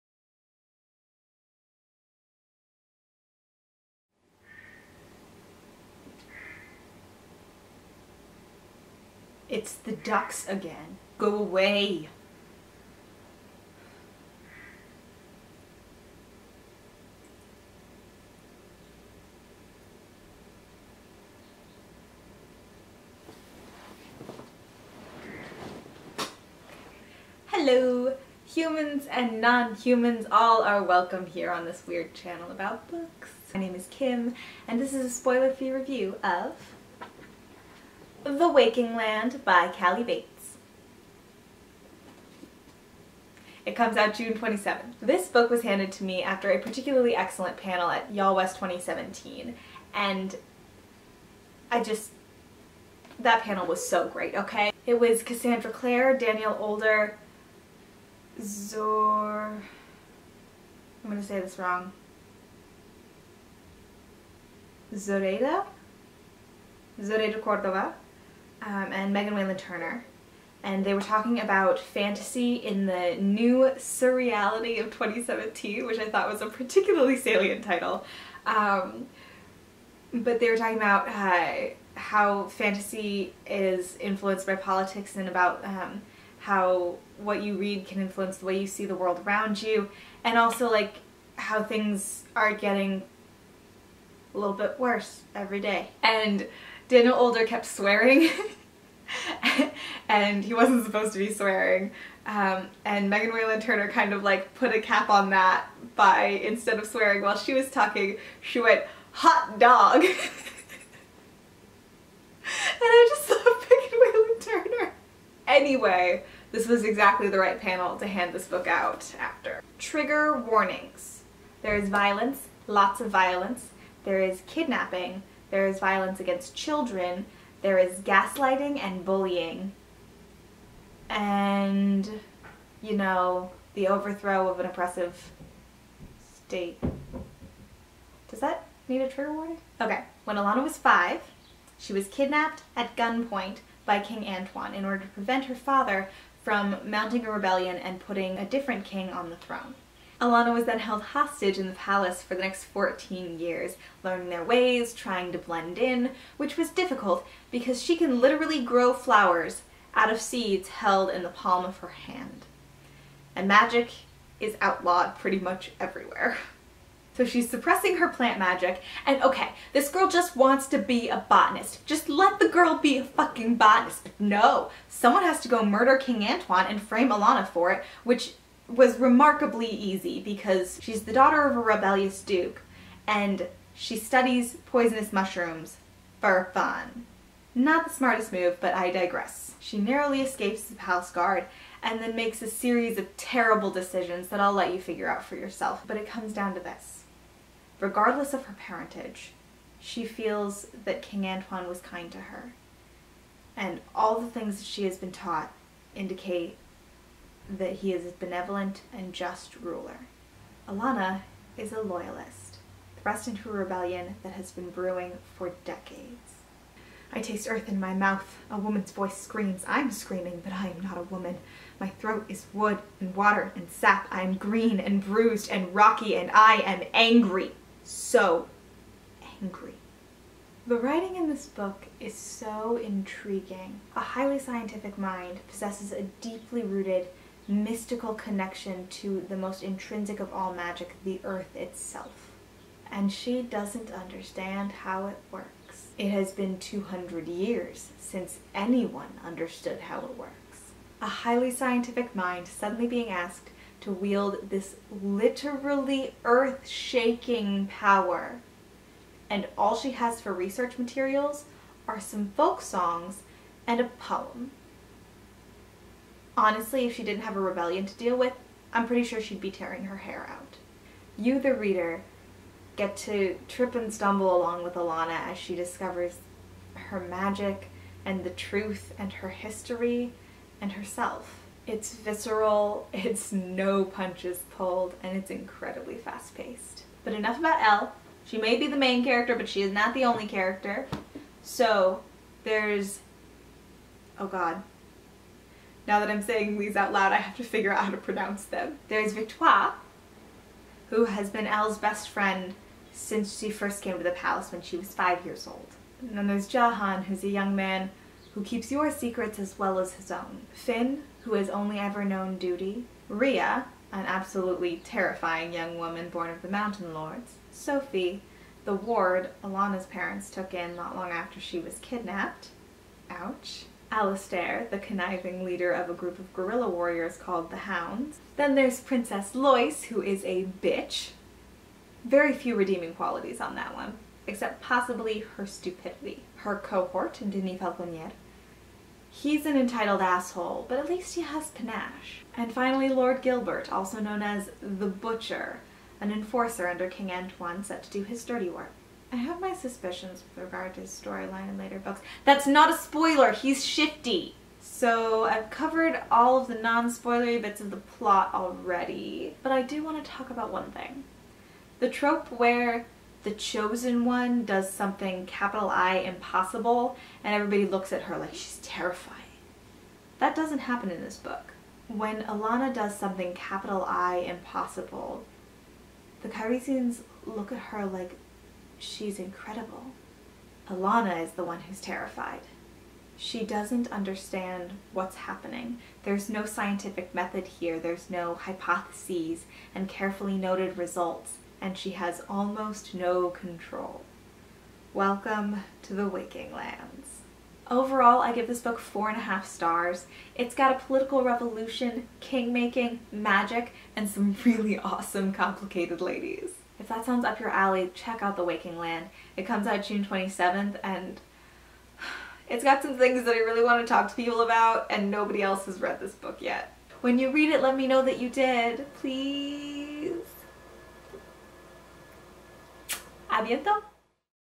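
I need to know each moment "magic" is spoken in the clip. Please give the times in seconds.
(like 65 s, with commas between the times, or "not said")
163 s, 168 s, 240 s, 277 s, 403 s.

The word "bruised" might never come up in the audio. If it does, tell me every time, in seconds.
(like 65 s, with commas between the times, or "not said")
225 s.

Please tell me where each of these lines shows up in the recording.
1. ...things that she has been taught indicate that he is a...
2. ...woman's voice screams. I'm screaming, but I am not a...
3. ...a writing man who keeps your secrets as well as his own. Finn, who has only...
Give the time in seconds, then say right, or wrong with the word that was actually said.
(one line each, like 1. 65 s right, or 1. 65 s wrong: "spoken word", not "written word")
1. 204 s right
2. 218 s right
3. 307 s wrong: "young", not "writing".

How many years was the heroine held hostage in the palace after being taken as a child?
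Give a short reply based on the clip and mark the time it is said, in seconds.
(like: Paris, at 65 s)
14, at 152 s.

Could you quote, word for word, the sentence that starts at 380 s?
Elanna is the one who's terrified.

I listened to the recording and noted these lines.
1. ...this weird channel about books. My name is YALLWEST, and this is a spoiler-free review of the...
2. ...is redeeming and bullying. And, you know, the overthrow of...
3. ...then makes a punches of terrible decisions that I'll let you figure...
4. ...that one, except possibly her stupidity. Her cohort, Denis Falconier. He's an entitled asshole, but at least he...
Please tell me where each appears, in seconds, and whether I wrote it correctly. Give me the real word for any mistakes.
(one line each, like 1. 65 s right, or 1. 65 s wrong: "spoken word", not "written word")
1. 31 s wrong: "Kim", not "YALLWEST"
2. 127 s wrong: "gaslighting", not "redeeming"
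3. 191 s wrong: "series", not "punches"
4. 333 s right.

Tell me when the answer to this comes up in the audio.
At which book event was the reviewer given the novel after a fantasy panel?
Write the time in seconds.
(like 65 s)
48 s.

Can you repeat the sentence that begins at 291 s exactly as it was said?
So there's, oh god, now that I'm saying these out loud, I have to figure out how to pronounce them.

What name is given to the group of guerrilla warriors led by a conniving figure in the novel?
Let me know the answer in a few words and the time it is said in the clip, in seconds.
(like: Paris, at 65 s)
The Hounds, at 327 s.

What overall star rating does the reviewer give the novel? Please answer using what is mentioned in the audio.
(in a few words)
4.5 stars.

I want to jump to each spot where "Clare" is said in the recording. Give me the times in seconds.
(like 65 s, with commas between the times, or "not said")
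55 s.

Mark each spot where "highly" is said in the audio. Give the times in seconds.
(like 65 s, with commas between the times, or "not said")
233 s, 251 s.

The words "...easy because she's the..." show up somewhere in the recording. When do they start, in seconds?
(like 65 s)
179 s.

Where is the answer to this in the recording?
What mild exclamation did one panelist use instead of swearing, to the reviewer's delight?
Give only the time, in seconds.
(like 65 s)
109 s.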